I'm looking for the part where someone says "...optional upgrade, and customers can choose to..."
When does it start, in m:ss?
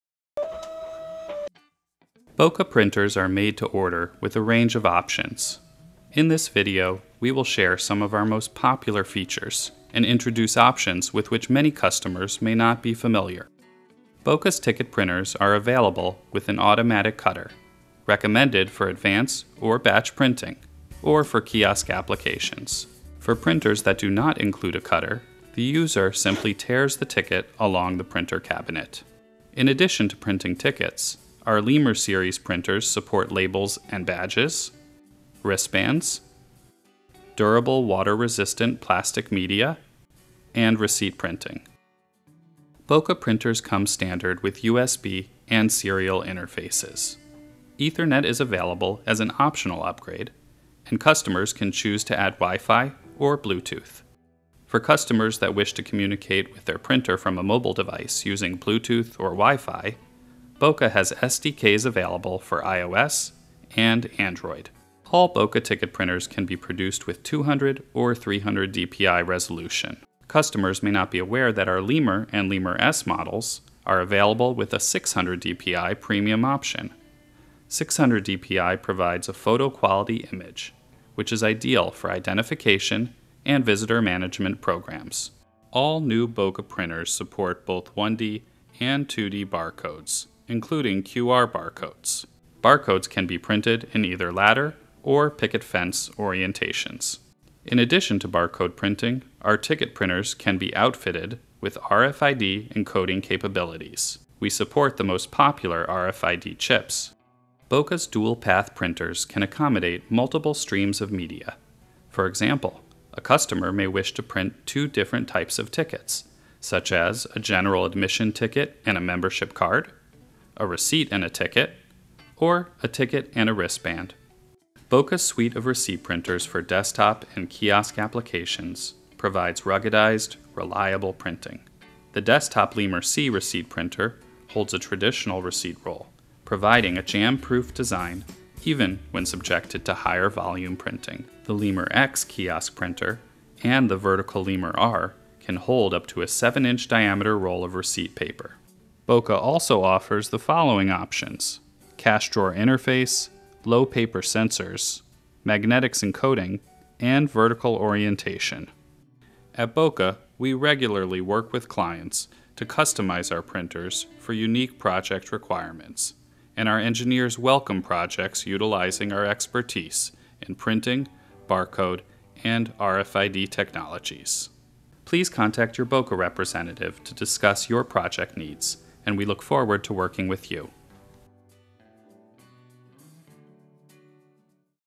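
0:49.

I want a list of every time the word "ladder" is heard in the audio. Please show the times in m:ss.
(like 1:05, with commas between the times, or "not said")
1:34.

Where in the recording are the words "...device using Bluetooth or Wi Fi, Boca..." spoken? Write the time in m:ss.
0:57.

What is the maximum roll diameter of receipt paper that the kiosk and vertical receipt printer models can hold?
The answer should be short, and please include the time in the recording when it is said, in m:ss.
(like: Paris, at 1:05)
7 inches, at 2:26.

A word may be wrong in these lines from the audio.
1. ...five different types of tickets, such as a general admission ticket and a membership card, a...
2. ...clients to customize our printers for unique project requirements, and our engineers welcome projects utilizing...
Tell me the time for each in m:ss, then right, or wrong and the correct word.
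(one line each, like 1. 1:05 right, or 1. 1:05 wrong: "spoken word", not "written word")
1. 1:54 wrong: "two", not "five"
2. 2:41 right.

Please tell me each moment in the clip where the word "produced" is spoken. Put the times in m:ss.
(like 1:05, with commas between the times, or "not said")
1:06.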